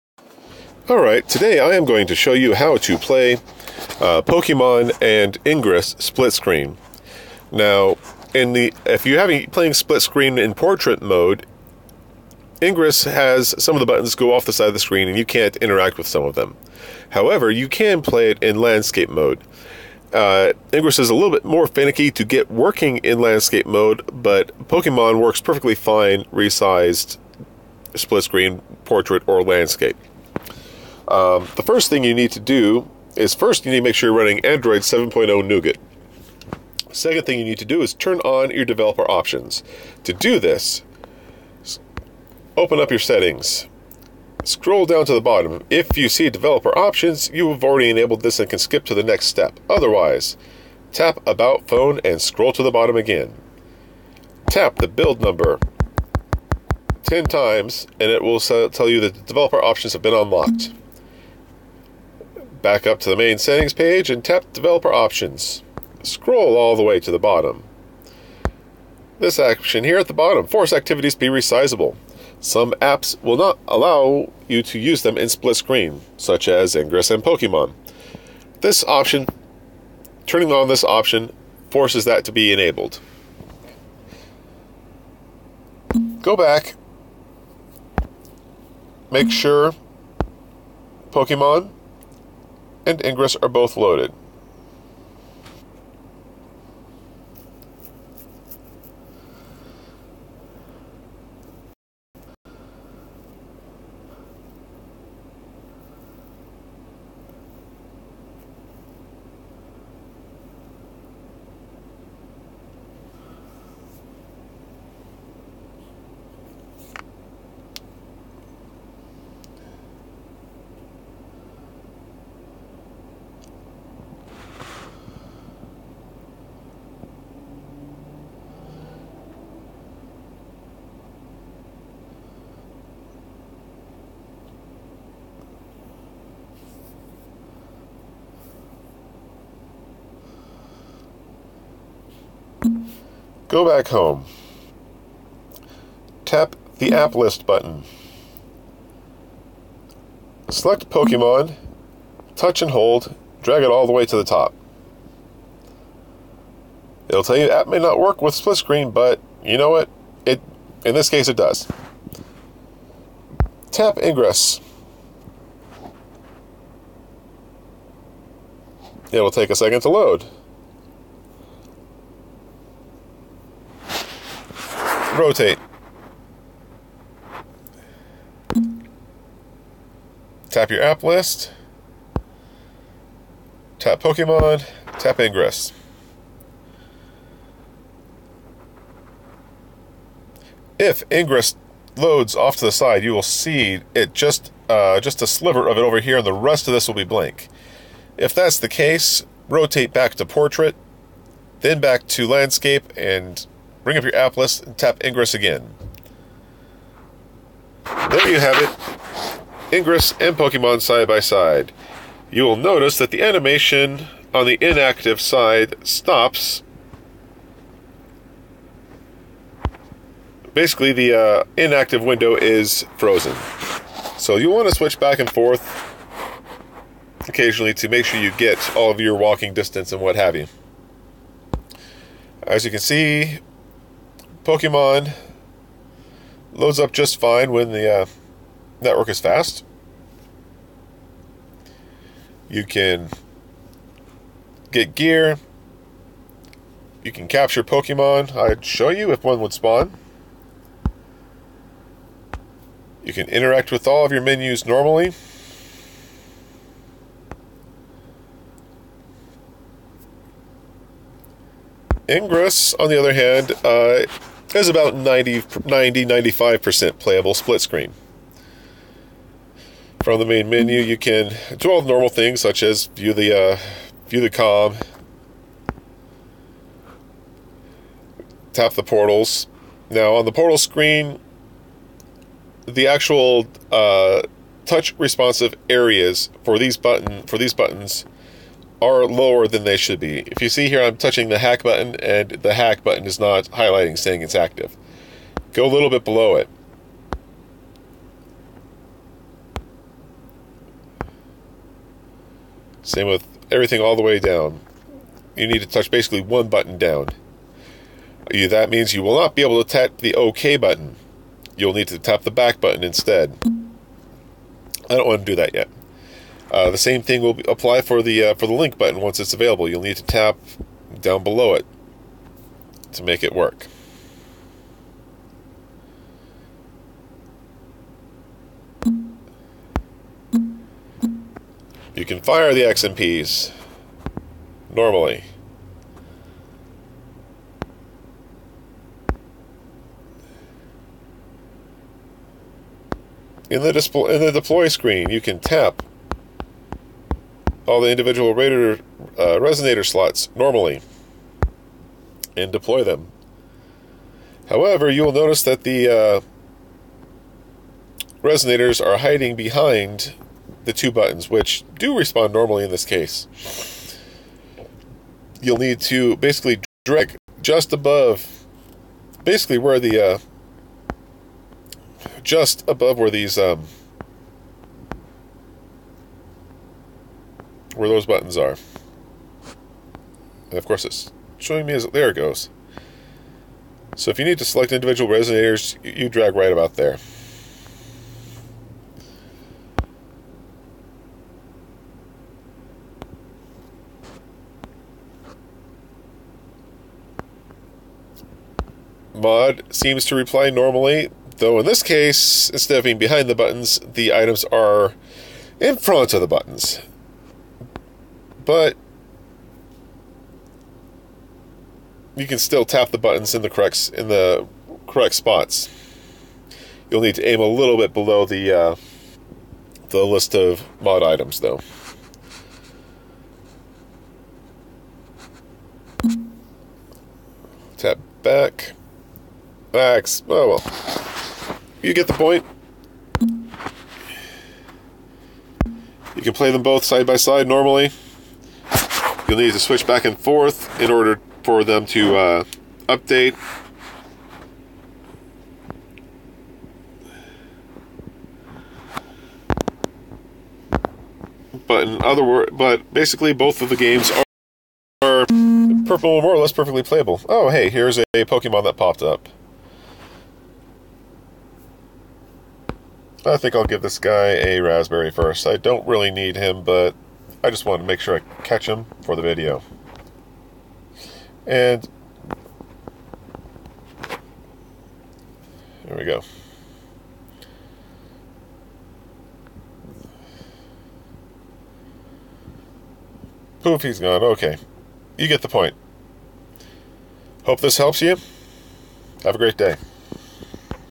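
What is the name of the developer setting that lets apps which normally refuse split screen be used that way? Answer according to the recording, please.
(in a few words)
Force activities be resizable.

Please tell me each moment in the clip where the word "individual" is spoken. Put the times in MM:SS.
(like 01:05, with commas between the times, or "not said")
05:47, 06:24.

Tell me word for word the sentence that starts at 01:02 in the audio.
Back up to the main settings page and tap Developer Options.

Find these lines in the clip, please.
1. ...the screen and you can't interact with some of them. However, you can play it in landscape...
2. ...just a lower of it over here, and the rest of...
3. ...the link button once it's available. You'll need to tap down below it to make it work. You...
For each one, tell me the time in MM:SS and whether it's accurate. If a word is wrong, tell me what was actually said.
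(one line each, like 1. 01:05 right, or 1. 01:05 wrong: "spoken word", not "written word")
1. 00:14 right
2. 03:15 wrong: "sliver", not "lower"
3. 05:18 right.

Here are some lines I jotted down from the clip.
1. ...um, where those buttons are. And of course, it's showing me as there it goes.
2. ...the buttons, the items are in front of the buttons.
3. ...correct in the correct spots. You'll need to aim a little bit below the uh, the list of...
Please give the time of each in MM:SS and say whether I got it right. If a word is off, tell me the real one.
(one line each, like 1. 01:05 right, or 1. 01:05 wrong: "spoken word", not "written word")
1. 06:13 right
2. 06:43 right
3. 06:53 right.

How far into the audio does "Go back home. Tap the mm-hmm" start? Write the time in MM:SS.
02:23.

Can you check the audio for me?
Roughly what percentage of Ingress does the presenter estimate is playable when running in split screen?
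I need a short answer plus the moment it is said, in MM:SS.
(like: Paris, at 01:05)
95%, at 04:26.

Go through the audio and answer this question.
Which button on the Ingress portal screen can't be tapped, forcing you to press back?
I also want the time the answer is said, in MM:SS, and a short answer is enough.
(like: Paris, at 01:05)
OK, at 05:10.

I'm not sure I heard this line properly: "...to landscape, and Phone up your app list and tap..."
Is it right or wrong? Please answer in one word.
wrong.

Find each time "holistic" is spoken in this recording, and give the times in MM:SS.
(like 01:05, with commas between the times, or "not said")
not said.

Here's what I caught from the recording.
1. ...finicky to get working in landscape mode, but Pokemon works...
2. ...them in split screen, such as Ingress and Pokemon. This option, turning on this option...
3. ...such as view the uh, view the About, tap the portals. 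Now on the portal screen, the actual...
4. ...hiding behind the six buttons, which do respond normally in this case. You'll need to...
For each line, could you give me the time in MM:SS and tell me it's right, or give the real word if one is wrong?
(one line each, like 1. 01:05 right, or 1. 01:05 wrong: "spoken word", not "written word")
1. 00:21 right
2. 01:15 right
3. 04:32 wrong: "COMM", not "About"
4. 05:58 wrong: "two", not "six".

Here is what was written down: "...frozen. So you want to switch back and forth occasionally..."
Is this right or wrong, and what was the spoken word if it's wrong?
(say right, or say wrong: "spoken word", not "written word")
right.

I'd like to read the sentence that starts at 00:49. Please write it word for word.
Otherwise, tap About Phone and scroll to the bottom again.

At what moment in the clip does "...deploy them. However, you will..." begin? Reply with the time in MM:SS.
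05:52.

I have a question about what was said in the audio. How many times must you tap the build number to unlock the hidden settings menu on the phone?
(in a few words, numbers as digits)
10.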